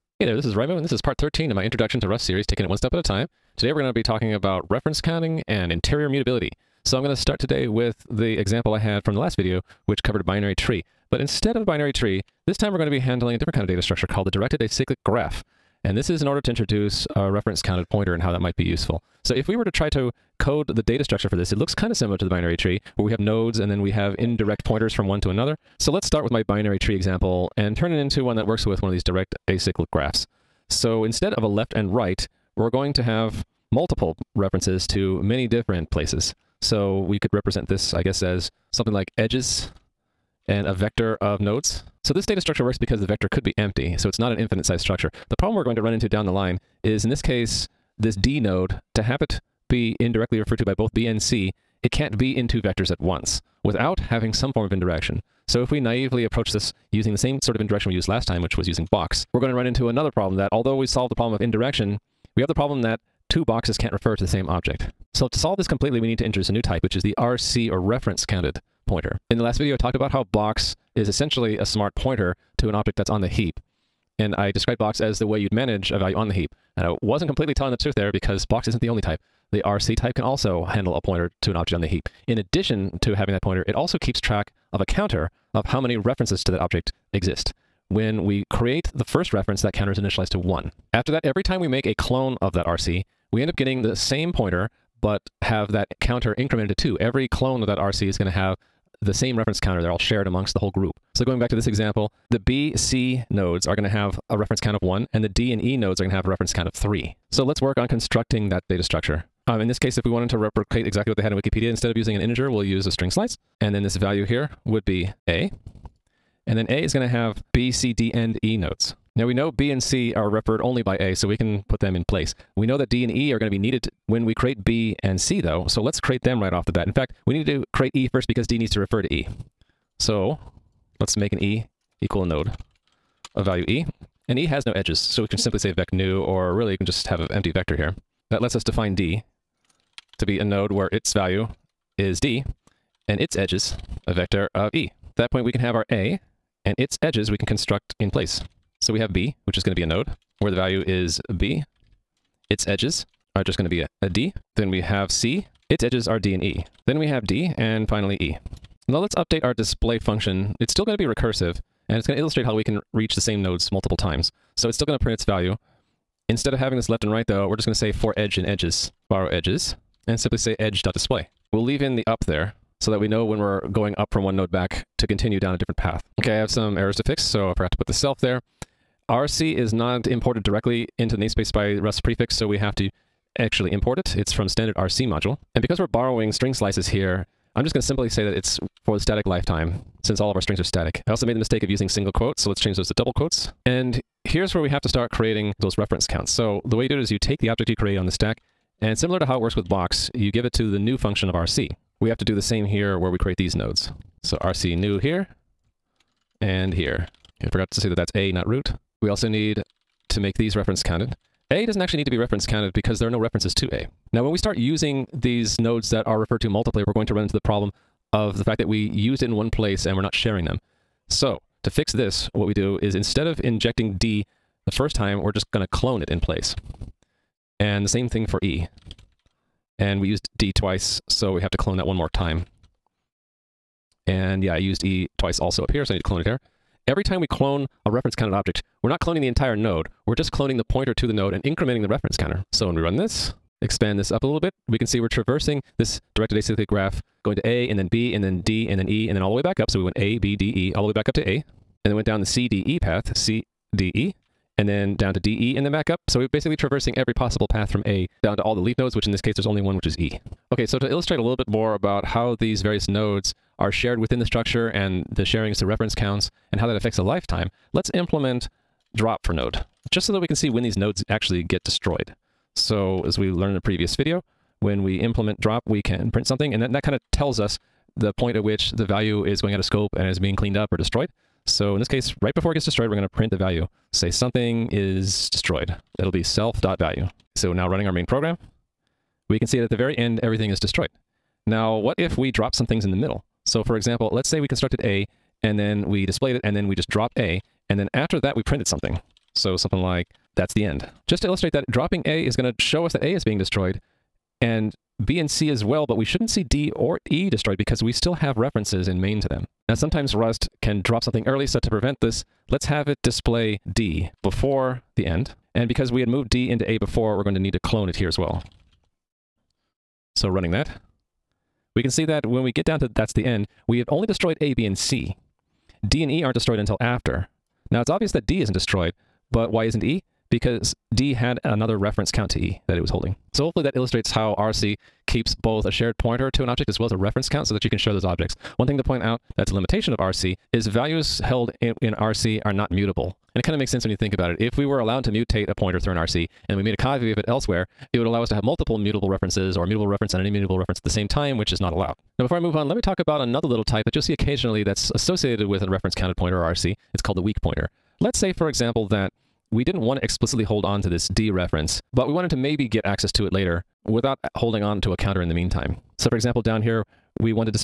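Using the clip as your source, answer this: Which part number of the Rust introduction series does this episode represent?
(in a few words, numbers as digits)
13.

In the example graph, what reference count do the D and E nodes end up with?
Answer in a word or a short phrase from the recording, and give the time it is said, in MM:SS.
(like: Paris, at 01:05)
3, at 01:46.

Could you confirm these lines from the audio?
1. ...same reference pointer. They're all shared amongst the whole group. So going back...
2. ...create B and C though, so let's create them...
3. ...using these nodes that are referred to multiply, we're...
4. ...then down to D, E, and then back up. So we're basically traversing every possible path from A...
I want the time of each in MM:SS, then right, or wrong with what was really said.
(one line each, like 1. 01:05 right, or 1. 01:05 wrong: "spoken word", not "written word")
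1. 01:39 wrong: "counter", not "pointer"
2. 02:04 right
3. 03:34 right
4. 04:14 right.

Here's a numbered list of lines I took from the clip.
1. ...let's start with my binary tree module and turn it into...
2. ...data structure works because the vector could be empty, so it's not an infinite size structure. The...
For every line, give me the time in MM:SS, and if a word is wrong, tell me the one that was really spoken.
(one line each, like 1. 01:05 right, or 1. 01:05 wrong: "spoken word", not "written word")
1. 00:25 wrong: "example", not "module"
2. 00:42 right.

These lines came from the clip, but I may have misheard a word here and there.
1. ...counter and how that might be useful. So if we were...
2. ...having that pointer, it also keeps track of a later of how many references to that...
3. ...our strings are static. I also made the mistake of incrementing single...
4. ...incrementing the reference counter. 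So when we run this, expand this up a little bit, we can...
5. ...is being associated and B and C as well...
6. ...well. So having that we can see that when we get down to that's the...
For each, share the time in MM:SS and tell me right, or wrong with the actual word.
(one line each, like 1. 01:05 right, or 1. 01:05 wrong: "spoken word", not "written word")
1. 00:17 wrong: "pointer", not "counter"
2. 01:23 wrong: "counter", not "later"
3. 03:10 wrong: "using", not "incrementing"
4. 04:01 right
5. 05:03 wrong: "destroyed", not "associated"
6. 05:18 wrong: "running", not "having".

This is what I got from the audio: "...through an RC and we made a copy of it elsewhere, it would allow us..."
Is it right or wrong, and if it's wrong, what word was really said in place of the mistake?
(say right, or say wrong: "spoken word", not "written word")
right.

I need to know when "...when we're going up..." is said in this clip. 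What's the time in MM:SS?
02:53.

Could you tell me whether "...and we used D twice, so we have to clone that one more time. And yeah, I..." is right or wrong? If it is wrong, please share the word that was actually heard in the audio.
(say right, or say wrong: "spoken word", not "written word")
right.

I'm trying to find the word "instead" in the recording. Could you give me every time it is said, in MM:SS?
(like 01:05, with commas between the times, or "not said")
00:11, 00:31, 01:51, 02:46, 03:42.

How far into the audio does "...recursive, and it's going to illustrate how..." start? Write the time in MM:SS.
02:41.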